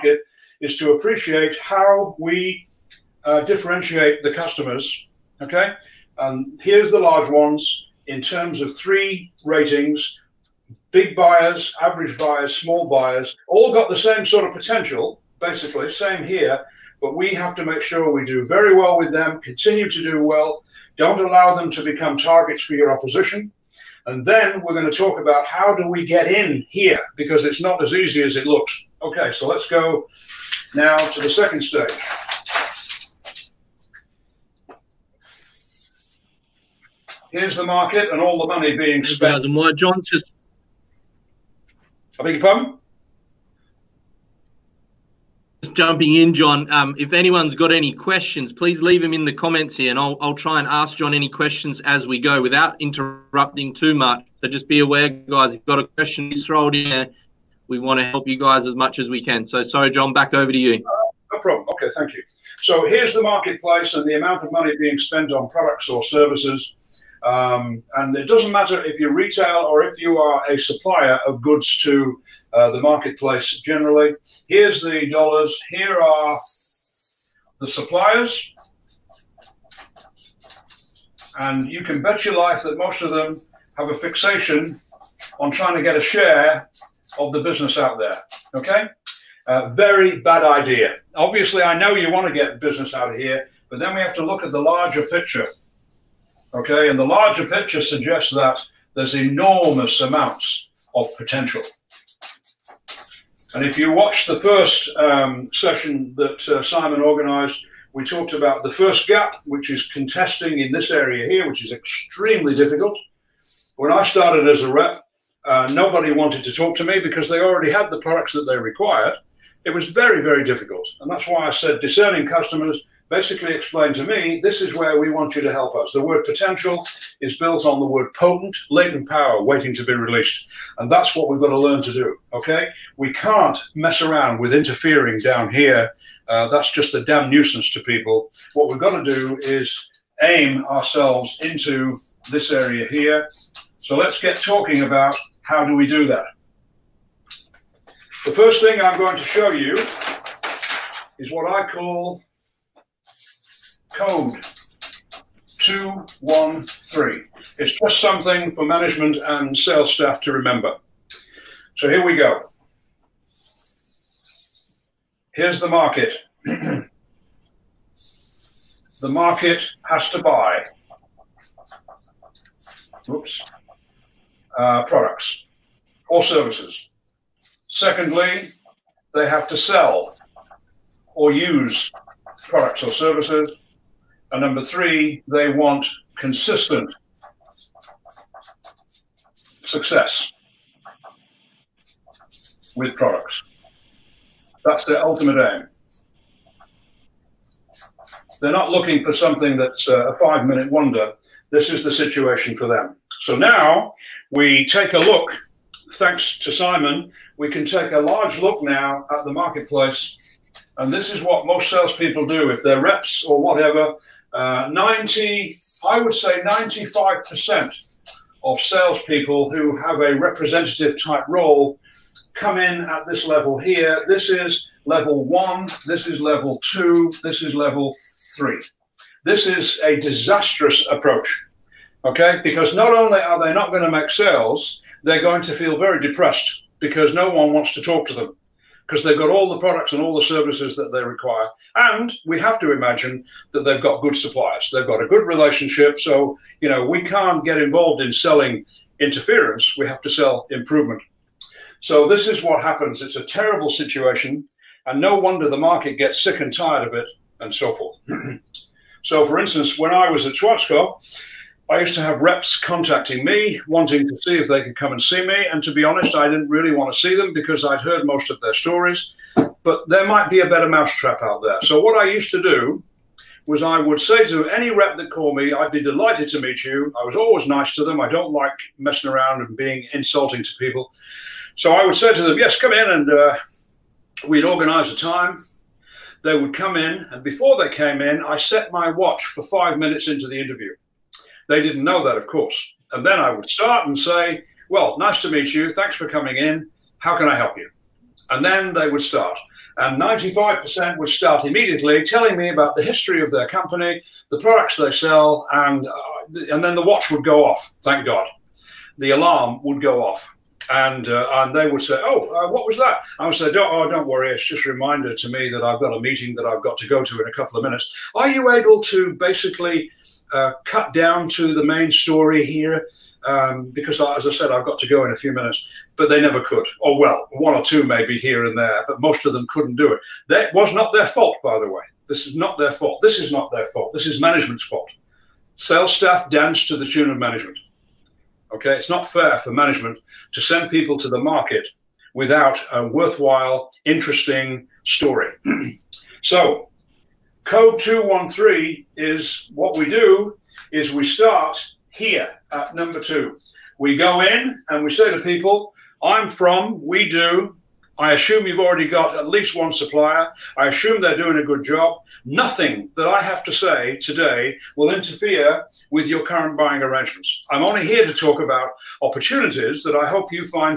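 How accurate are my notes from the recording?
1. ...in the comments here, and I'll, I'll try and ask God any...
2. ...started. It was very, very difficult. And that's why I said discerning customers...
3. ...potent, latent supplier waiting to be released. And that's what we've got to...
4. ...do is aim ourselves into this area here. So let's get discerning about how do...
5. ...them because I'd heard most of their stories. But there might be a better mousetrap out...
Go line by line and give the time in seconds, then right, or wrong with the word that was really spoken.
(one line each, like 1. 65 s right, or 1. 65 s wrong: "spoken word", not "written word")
1. 49 s wrong: "John", not "God"
2. 118 s wrong: "required", not "started"
3. 128 s wrong: "power", not "supplier"
4. 139 s wrong: "talking", not "discerning"
5. 267 s right.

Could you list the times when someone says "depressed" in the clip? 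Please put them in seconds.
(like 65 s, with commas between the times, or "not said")
236 s.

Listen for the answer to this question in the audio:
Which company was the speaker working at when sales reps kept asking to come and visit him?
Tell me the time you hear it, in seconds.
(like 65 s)
260 s.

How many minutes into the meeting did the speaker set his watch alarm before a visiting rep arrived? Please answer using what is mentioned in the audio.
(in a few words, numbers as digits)
5.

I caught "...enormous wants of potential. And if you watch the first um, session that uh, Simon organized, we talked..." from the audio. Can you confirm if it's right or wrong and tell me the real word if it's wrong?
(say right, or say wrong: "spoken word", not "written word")
wrong: "amounts", not "wants".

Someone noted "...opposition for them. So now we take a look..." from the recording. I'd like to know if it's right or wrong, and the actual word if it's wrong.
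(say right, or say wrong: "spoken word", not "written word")
wrong: "situation", not "opposition".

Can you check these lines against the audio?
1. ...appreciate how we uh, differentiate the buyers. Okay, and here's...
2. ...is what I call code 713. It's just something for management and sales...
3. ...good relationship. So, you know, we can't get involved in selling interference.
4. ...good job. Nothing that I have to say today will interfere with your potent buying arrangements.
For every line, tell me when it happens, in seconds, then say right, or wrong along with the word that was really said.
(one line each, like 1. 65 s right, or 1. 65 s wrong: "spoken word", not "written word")
1. 0 s wrong: "customers", not "buyers"
2. 151 s wrong: "213", not "713"
3. 245 s right
4. 361 s wrong: "current", not "potent".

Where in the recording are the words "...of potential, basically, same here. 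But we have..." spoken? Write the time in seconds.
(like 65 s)
14 s.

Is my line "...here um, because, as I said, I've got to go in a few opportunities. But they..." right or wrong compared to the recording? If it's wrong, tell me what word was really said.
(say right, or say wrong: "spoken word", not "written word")
wrong: "minutes", not "opportunities".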